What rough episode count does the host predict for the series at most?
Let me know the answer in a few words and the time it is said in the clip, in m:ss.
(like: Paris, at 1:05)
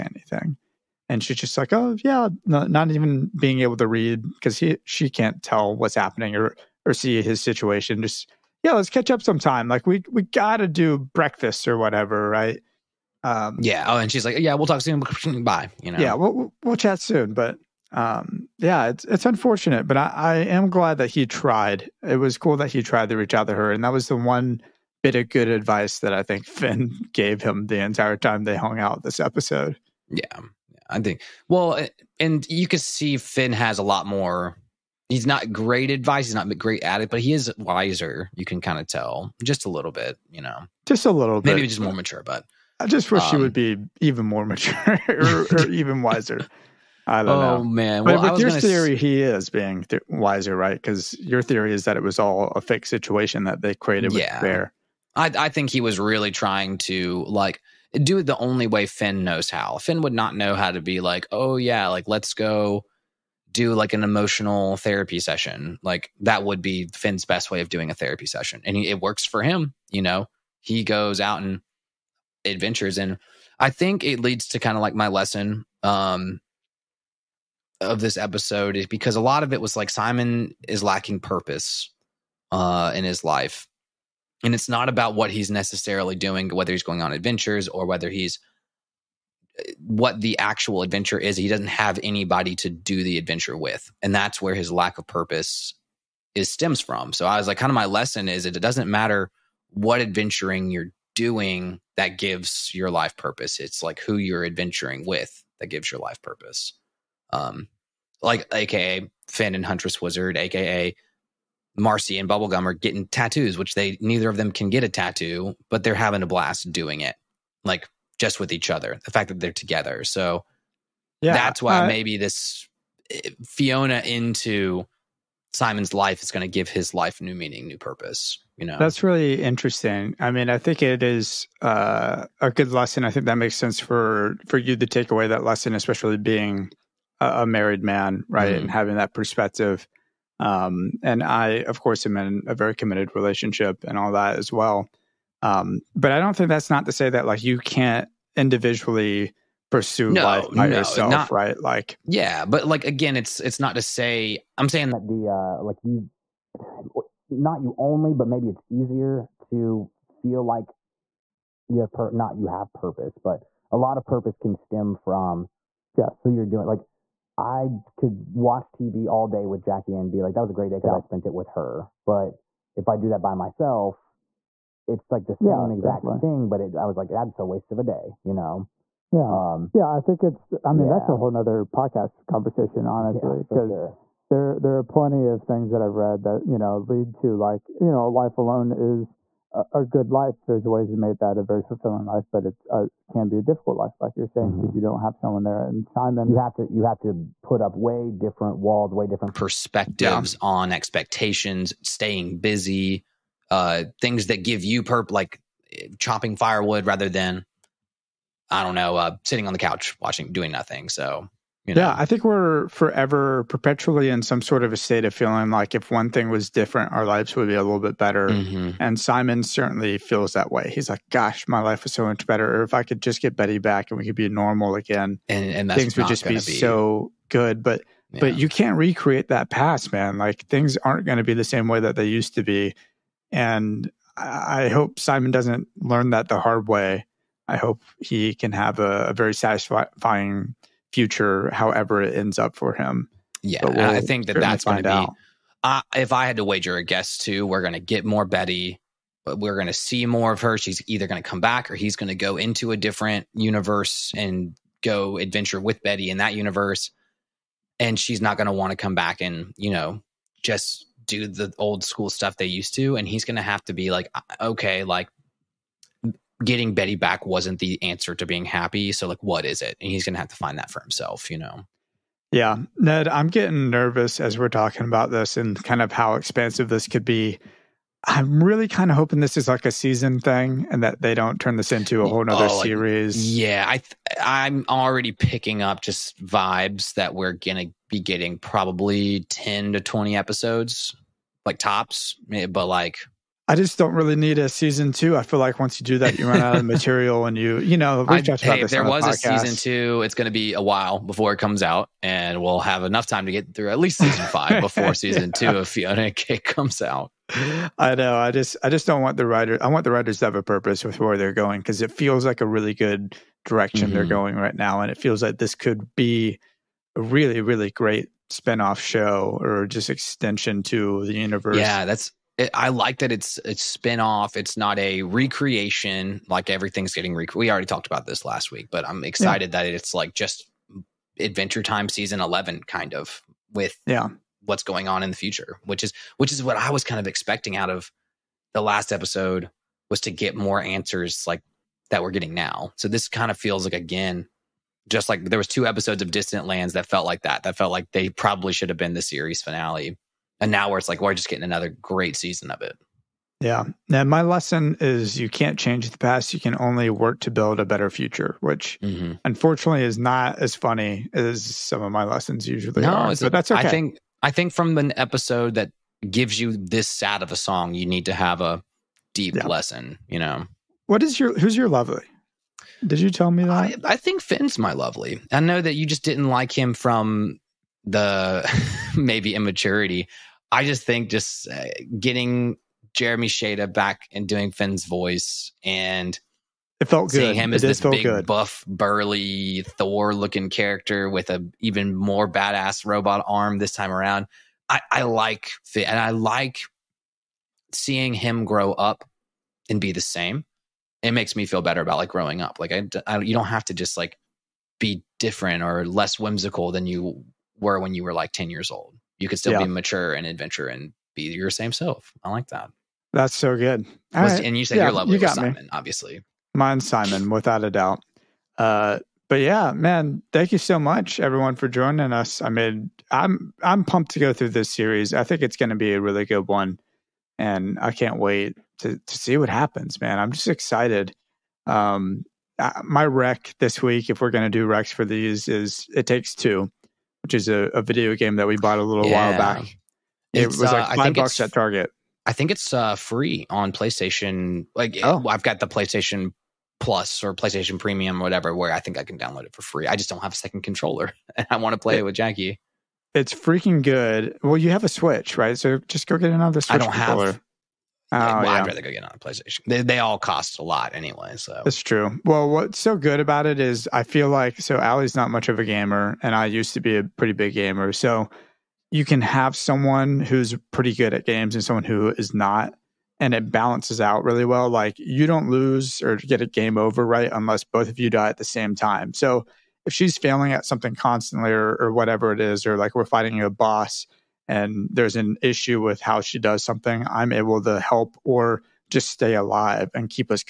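10 to 20, at 4:49.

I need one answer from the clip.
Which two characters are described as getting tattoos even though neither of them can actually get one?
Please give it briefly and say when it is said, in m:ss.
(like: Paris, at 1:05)
Marcy and Bubblegum, at 1:51.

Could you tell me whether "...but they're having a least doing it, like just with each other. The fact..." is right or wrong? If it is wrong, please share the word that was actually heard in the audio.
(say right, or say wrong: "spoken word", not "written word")
wrong: "blast", not "least".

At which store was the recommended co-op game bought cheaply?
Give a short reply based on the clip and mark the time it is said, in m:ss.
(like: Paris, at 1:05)
Target, at 7:21.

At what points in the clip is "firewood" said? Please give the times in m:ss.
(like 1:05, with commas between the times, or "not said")
3:26.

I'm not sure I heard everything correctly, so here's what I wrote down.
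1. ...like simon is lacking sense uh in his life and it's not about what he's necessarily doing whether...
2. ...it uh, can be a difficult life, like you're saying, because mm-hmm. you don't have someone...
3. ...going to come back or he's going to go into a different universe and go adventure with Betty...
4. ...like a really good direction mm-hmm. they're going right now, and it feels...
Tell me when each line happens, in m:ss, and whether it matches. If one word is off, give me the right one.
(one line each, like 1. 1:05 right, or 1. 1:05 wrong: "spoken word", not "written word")
1. 1:19 wrong: "purpose", not "sense"
2. 3:12 right
3. 4:11 right
4. 5:12 right.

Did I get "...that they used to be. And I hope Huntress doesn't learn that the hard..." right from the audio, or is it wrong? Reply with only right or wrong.
wrong.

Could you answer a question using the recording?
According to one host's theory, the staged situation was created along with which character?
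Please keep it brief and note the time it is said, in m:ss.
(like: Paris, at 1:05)
Bear, at 0:54.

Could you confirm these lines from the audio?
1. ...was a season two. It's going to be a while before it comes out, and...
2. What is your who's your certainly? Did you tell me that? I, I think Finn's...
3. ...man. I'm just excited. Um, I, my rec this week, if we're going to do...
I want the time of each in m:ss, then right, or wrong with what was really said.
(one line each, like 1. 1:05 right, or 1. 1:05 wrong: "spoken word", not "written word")
1. 4:58 right
2. 6:10 wrong: "lovely", not "certainly"
3. 7:10 right.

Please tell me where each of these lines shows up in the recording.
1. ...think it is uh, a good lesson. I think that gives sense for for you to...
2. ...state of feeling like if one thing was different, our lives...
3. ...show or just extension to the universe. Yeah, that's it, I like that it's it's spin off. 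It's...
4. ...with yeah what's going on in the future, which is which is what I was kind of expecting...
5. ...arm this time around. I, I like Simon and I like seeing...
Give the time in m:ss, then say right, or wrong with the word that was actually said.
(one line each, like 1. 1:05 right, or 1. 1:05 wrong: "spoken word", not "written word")
1. 2:10 wrong: "makes", not "gives"
2. 3:34 right
3. 5:18 right
4. 5:33 right
5. 6:33 wrong: "Finn", not "Simon".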